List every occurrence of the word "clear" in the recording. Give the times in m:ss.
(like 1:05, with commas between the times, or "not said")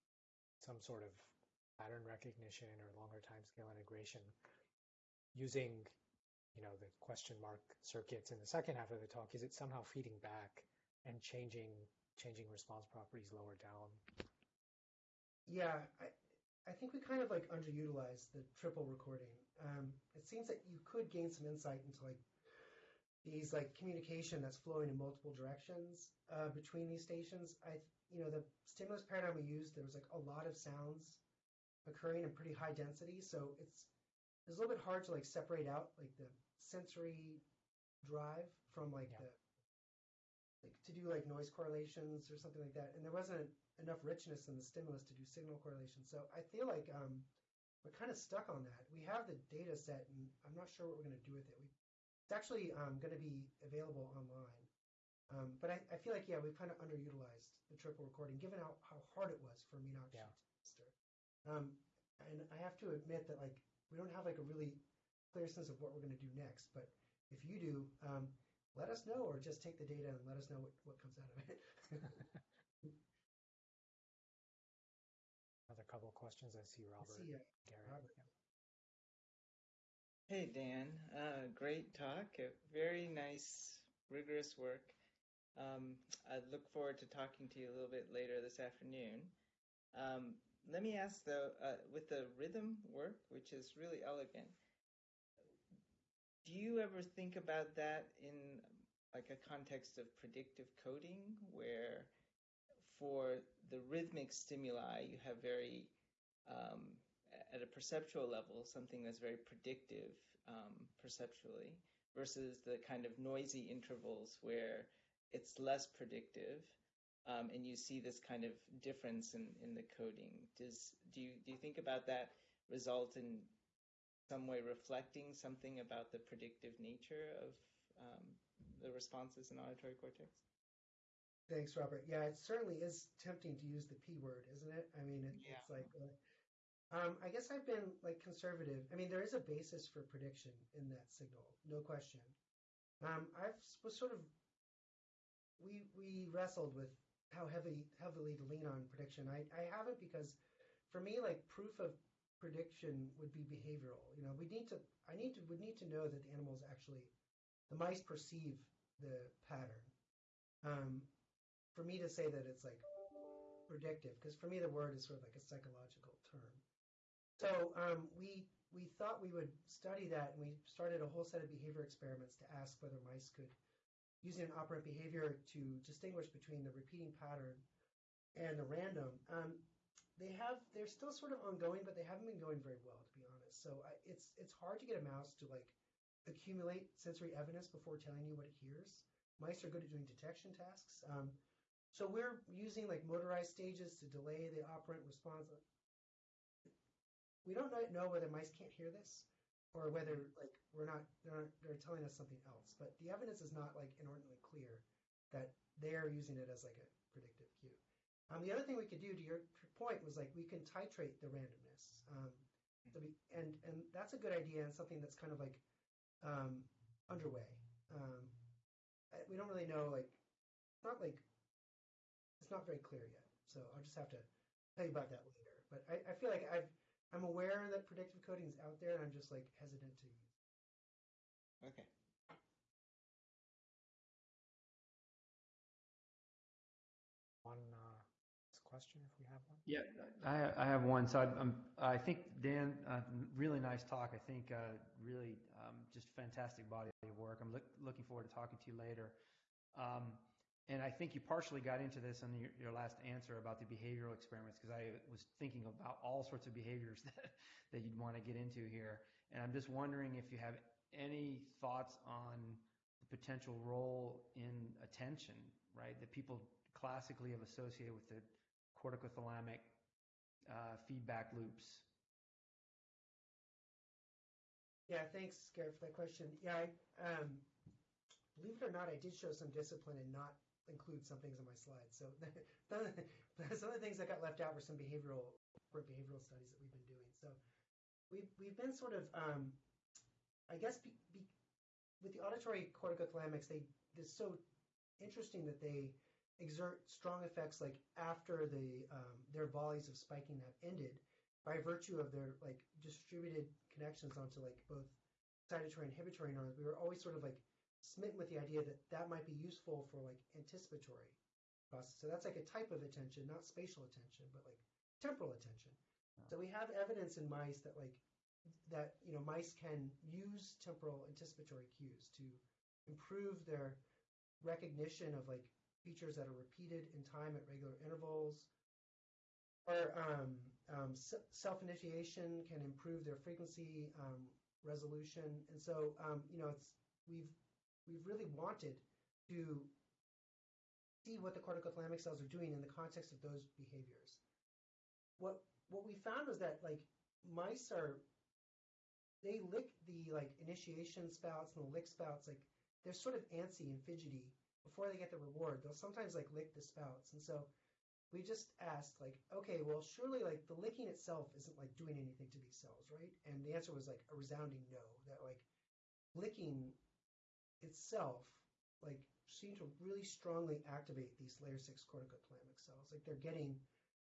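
1:05, 3:24, 3:42.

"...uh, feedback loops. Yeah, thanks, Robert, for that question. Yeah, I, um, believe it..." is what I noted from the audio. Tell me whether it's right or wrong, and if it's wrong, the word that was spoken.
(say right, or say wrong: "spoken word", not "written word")
wrong: "Gary", not "Robert".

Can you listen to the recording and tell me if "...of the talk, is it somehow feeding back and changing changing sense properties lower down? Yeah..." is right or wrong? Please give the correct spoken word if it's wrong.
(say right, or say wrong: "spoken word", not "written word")
wrong: "response", not "sense".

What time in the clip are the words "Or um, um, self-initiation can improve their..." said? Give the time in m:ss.
5:29.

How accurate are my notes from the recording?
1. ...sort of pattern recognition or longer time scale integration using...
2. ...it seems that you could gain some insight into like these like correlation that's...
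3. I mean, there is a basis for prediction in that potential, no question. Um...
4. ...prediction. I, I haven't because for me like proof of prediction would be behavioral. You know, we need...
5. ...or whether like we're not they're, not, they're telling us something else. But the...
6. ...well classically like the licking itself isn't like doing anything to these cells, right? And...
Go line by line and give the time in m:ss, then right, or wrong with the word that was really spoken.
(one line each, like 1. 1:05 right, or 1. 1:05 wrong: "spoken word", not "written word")
1. 0:00 right
2. 0:20 wrong: "communication", not "correlation"
3. 2:18 wrong: "signal", not "potential"
4. 2:28 right
5. 3:19 right
6. 5:59 wrong: "surely", not "classically".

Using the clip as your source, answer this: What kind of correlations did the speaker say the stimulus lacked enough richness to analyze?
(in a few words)
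Signal correlation.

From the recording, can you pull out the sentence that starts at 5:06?
We were always sort of like smitten with the idea that that might be useful for like anticipatory process.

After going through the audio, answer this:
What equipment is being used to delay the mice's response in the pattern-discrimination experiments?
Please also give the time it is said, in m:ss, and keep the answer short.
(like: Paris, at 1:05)
Motorized stages, at 3:13.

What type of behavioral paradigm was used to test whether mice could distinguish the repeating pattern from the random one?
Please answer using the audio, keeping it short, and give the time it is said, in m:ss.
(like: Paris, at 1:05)
Operant behavior, at 2:54.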